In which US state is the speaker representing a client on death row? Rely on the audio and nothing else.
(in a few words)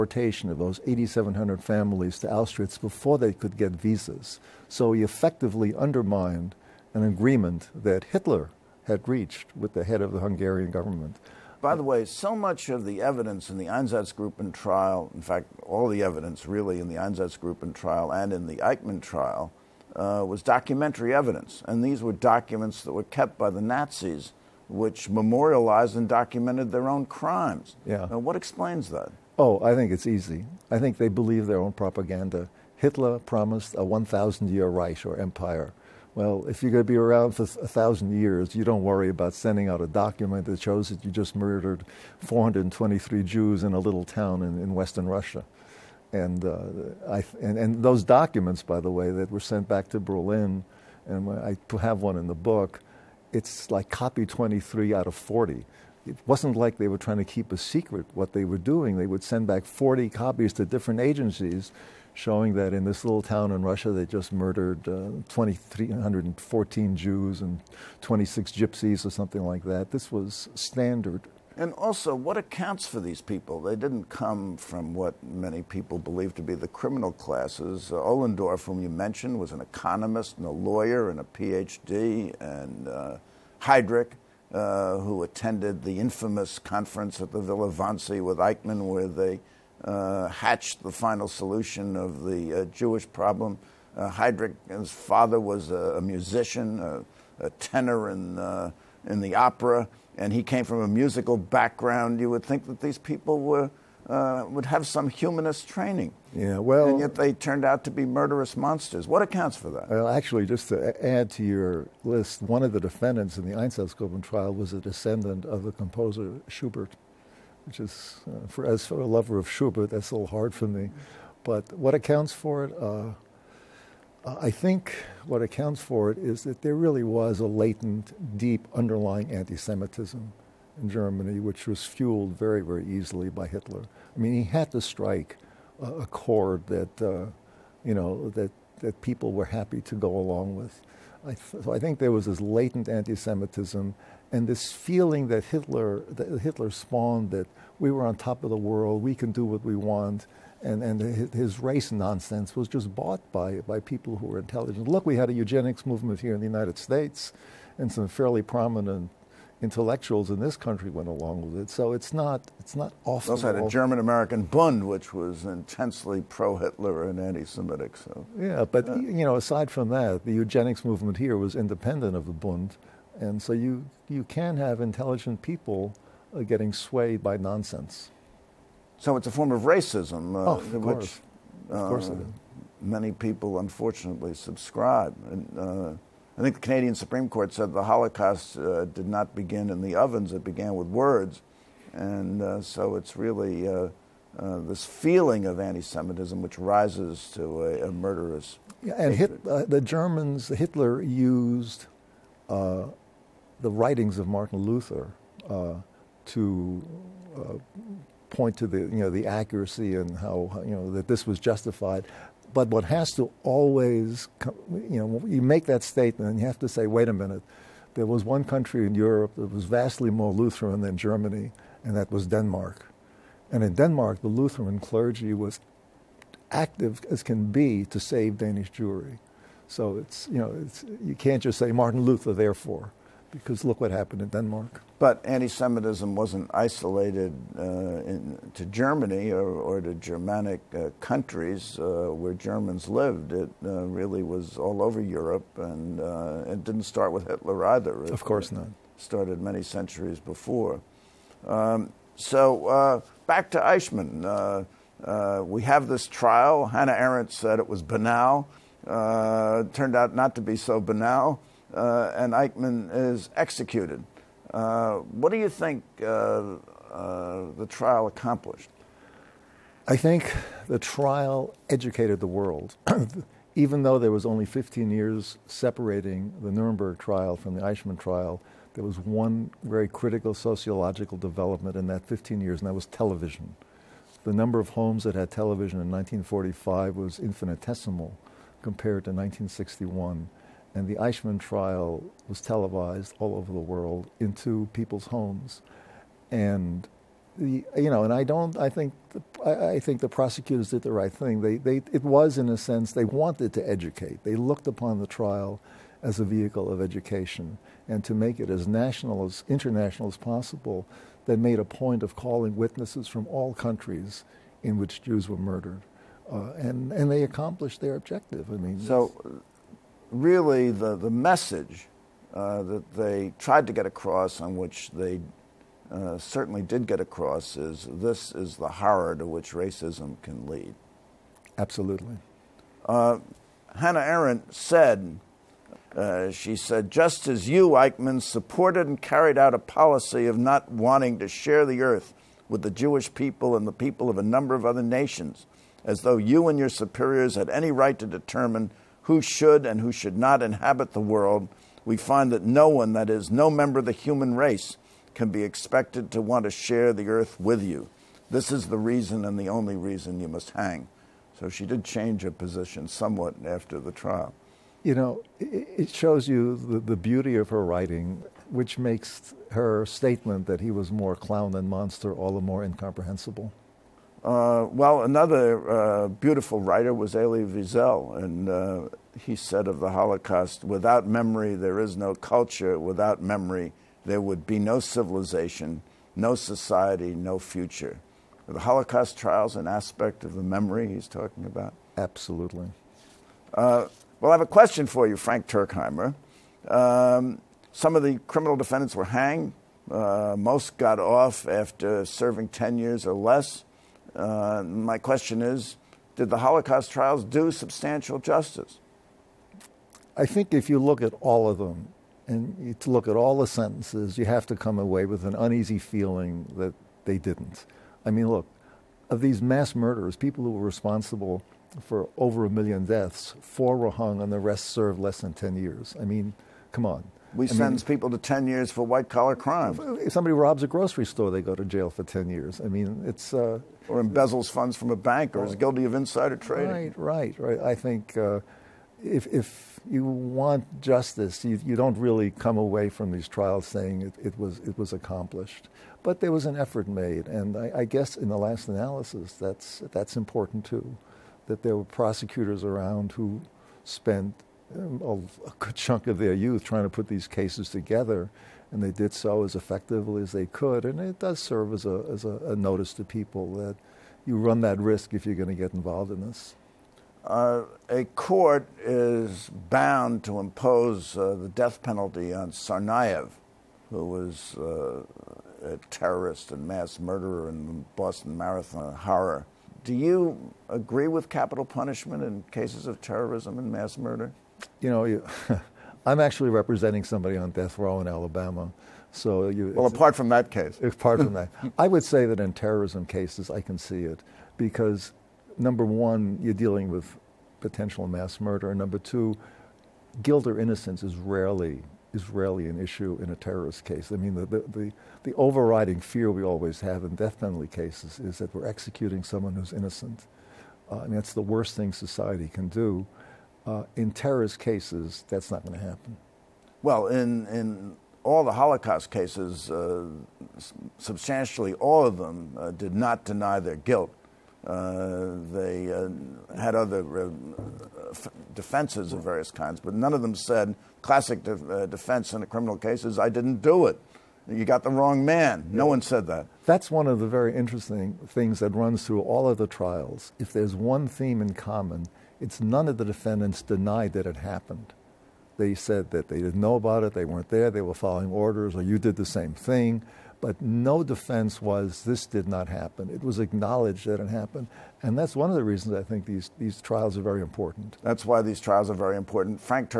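Alabama.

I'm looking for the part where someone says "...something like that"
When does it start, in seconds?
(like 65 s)
69 s.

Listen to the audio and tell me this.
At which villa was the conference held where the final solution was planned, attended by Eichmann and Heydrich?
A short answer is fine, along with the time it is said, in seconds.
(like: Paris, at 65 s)
Villa Wannsee, at 87 s.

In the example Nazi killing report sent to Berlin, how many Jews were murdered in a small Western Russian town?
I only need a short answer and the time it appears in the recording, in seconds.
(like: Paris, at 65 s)
423, at 42 s.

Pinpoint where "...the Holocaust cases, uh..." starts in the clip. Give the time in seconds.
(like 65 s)
518 s.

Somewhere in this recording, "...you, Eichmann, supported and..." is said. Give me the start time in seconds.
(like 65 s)
337 s.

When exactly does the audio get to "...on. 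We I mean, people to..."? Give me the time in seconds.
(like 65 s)
426 s.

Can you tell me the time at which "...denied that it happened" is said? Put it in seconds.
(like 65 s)
543 s.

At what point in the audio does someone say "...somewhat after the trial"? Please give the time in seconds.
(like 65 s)
362 s.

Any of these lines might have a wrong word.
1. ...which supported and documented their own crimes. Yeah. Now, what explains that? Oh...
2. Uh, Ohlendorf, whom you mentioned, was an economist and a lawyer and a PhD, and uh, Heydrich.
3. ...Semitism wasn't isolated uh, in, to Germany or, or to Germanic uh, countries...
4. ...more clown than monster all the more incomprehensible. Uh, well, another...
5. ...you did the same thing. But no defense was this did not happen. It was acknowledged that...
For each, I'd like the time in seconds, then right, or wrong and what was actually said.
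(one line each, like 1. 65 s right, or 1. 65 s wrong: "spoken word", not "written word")
1. 24 s wrong: "memorialized", not "supported"
2. 77 s right
3. 235 s right
4. 370 s right
5. 548 s right.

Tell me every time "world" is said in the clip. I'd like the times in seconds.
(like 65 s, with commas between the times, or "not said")
148 s, 272 s, 293 s, 350 s.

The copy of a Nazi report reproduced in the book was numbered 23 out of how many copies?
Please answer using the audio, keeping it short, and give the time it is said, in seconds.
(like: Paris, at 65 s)
40, at 53 s.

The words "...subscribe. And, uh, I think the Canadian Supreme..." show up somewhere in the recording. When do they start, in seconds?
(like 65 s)
184 s.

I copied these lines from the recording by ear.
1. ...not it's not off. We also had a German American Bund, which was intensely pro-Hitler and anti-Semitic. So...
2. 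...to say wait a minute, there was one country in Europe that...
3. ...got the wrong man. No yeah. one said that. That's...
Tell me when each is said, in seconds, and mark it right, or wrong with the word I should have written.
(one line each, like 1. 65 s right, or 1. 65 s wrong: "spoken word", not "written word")
1. 162 s right
2. 216 s right
3. 534 s right.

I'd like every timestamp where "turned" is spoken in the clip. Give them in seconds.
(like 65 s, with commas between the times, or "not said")
107 s, 258 s.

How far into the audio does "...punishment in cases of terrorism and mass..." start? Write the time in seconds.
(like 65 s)
481 s.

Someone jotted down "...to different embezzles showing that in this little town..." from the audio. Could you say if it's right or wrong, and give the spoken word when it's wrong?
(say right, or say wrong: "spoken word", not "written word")
wrong: "agencies", not "embezzles".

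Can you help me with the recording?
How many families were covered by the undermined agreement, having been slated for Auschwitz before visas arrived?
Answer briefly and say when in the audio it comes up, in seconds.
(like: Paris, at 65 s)
8,700, at 0 s.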